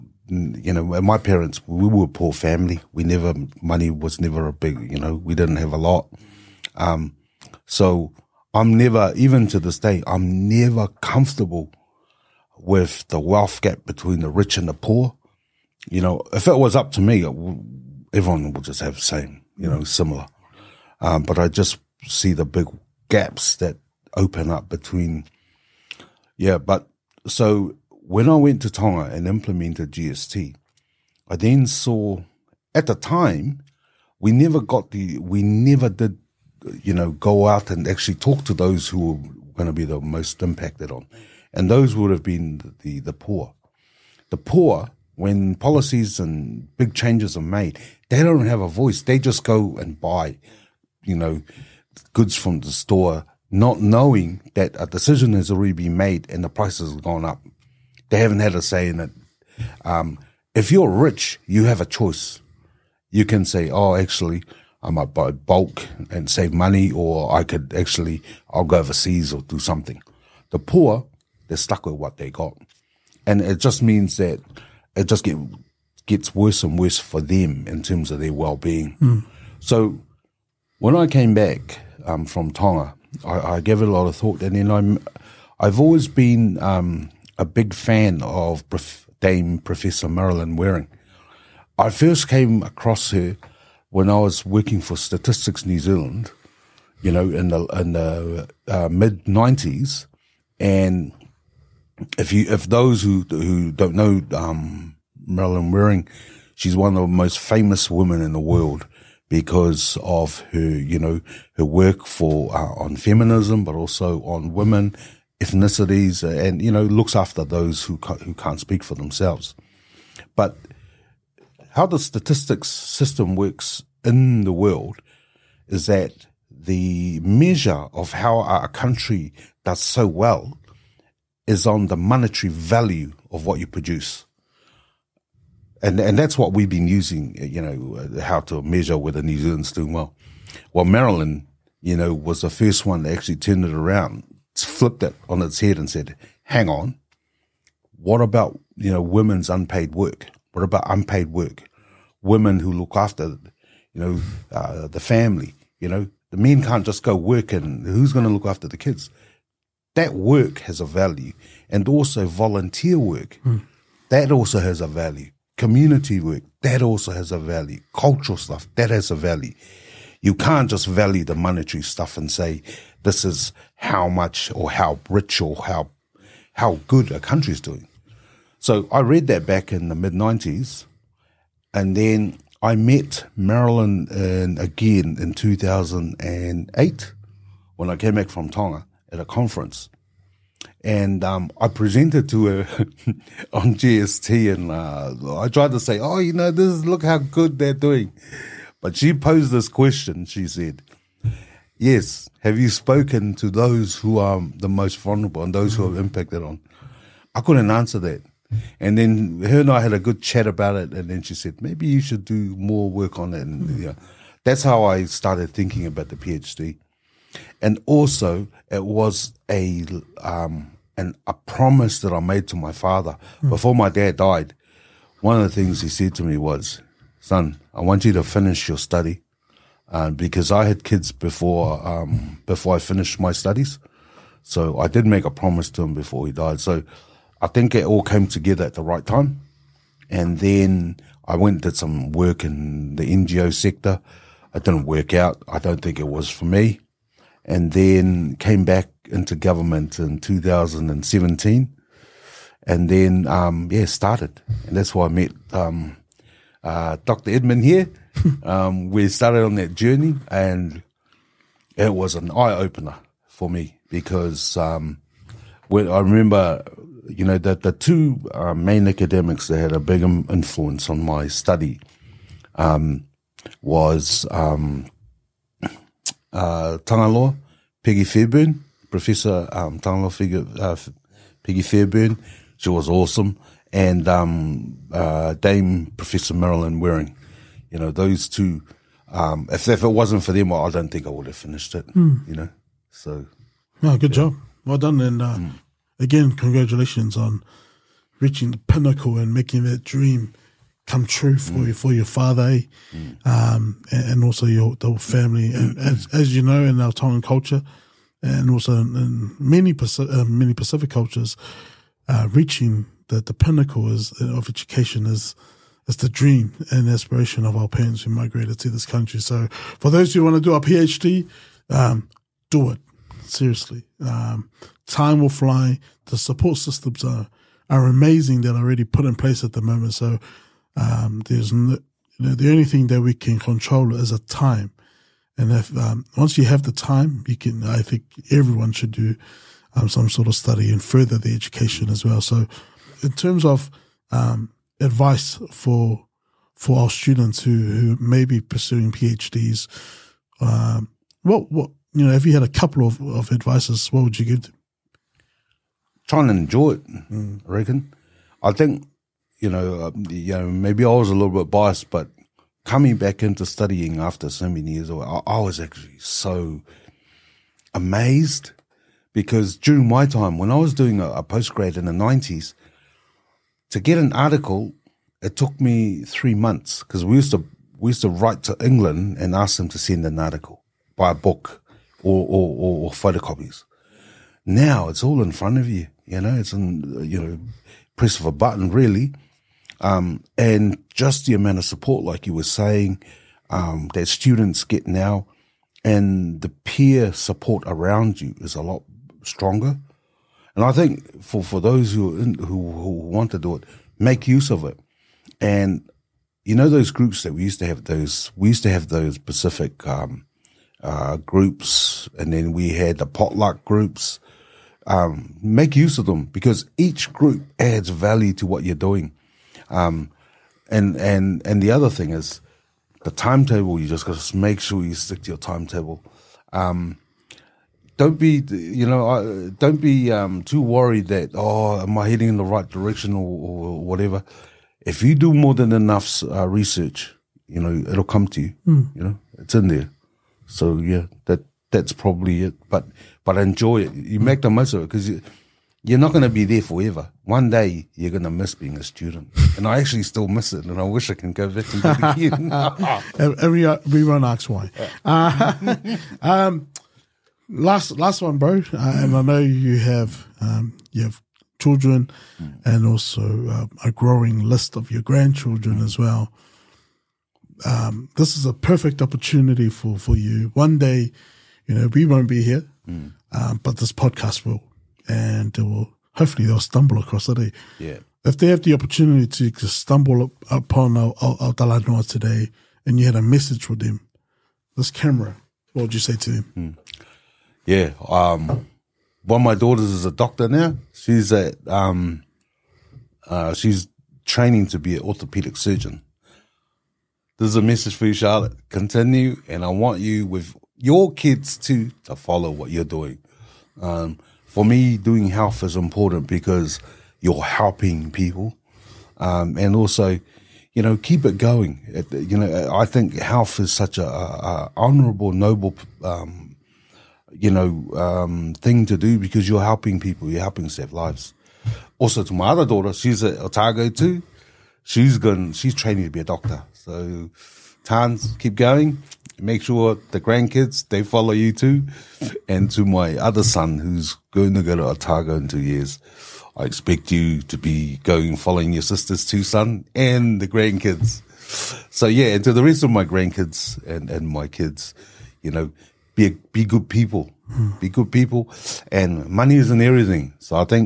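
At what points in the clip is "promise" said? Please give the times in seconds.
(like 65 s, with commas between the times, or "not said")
221 s, 235 s.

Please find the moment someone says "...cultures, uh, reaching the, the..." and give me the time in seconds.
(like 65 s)
310 s.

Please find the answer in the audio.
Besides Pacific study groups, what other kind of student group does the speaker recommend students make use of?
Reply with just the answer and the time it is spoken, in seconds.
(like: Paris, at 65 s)
potluck groups, at 413 s.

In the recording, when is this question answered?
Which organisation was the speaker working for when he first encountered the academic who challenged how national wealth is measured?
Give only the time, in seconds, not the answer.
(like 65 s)
94 s.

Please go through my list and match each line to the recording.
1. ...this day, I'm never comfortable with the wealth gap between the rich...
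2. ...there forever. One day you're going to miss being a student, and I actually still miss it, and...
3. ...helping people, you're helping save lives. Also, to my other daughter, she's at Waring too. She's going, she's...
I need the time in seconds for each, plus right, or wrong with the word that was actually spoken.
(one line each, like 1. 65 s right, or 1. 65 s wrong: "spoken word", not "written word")
1. 9 s right
2. 446 s right
3. 519 s wrong: "Otago", not "Waring".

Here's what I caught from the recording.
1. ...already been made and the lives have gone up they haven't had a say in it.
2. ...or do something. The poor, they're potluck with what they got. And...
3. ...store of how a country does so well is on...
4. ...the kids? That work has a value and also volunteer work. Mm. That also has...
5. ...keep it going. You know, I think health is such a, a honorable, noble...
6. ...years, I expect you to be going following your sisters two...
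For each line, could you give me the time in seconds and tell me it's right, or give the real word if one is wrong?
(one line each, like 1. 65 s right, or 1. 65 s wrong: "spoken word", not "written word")
1. 55 s wrong: "prices", not "lives"
2. 69 s wrong: "stuck", not "potluck"
3. 127 s wrong: "measure", not "store"
4. 158 s right
5. 510 s right
6. 535 s right.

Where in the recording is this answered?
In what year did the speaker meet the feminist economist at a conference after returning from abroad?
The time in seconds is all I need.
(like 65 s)
185 s.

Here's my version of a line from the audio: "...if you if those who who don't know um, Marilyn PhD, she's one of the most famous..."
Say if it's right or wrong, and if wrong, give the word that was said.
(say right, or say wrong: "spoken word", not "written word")
wrong: "Waring", not "PhD".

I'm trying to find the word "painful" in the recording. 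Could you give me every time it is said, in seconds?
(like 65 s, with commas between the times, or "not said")
not said.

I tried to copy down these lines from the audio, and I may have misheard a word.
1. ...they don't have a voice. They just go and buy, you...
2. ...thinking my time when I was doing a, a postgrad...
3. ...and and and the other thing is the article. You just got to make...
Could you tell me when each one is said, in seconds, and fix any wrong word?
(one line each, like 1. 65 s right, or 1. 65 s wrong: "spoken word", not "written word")
1. 48 s right
2. 369 s wrong: "during", not "thinking"
3. 420 s wrong: "timetable", not "article".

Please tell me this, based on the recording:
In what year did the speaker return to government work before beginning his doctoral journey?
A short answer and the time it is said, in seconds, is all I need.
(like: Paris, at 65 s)
2017, at 250 s.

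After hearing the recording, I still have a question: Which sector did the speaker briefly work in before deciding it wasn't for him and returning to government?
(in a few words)
NGO sector.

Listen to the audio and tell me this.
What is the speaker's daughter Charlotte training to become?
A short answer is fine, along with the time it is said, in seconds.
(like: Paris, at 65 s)
orthopedic surgeon, at 495 s.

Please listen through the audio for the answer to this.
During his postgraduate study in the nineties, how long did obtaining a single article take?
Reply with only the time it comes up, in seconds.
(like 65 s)
376 s.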